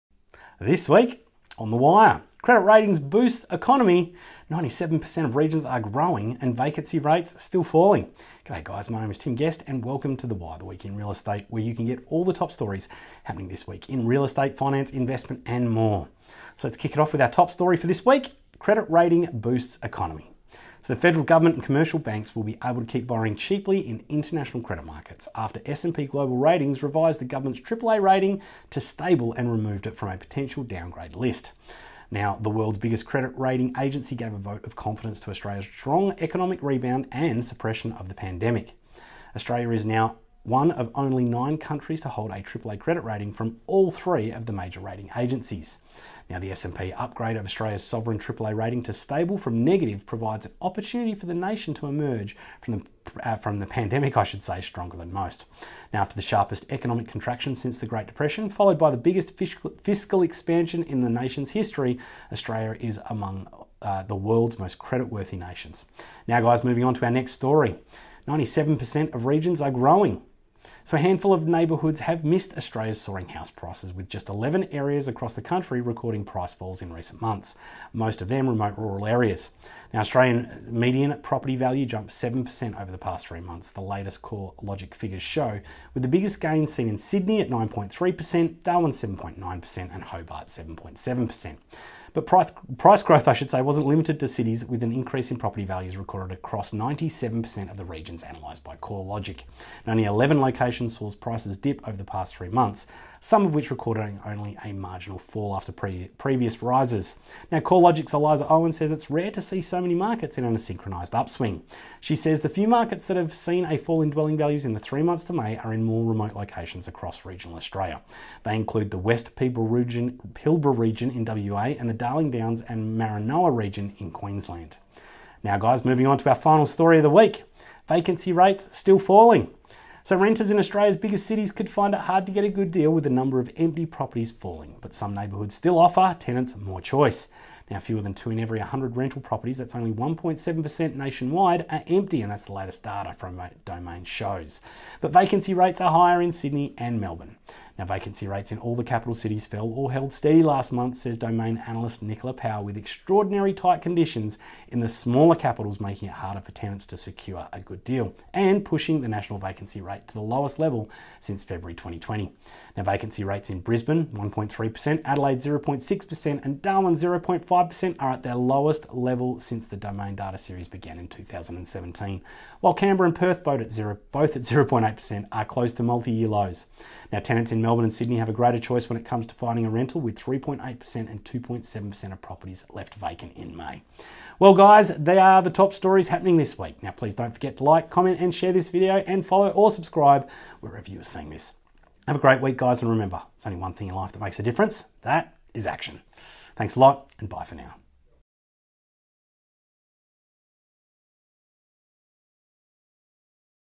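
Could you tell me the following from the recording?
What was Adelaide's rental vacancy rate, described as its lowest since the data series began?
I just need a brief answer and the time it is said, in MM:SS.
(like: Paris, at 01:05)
0.6%, at 02:45.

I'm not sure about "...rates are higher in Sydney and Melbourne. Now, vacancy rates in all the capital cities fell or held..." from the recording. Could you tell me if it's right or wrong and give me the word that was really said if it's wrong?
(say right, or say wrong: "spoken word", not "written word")
right.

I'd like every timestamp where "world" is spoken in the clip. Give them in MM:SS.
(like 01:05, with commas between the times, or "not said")
00:32, 01:04.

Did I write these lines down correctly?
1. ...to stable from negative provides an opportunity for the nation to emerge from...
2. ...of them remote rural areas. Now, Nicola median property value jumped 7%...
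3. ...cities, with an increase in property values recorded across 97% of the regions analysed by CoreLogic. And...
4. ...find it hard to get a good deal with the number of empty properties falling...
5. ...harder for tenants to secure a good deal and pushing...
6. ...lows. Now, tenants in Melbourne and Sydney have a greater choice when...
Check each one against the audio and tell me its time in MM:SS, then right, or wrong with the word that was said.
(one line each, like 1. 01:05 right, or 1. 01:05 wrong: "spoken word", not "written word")
1. 00:48 right
2. 01:18 wrong: "Australian", not "Nicola"
3. 01:34 right
4. 02:11 right
5. 02:36 right
6. 02:56 right.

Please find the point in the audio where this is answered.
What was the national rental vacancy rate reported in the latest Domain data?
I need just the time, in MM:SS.
02:19.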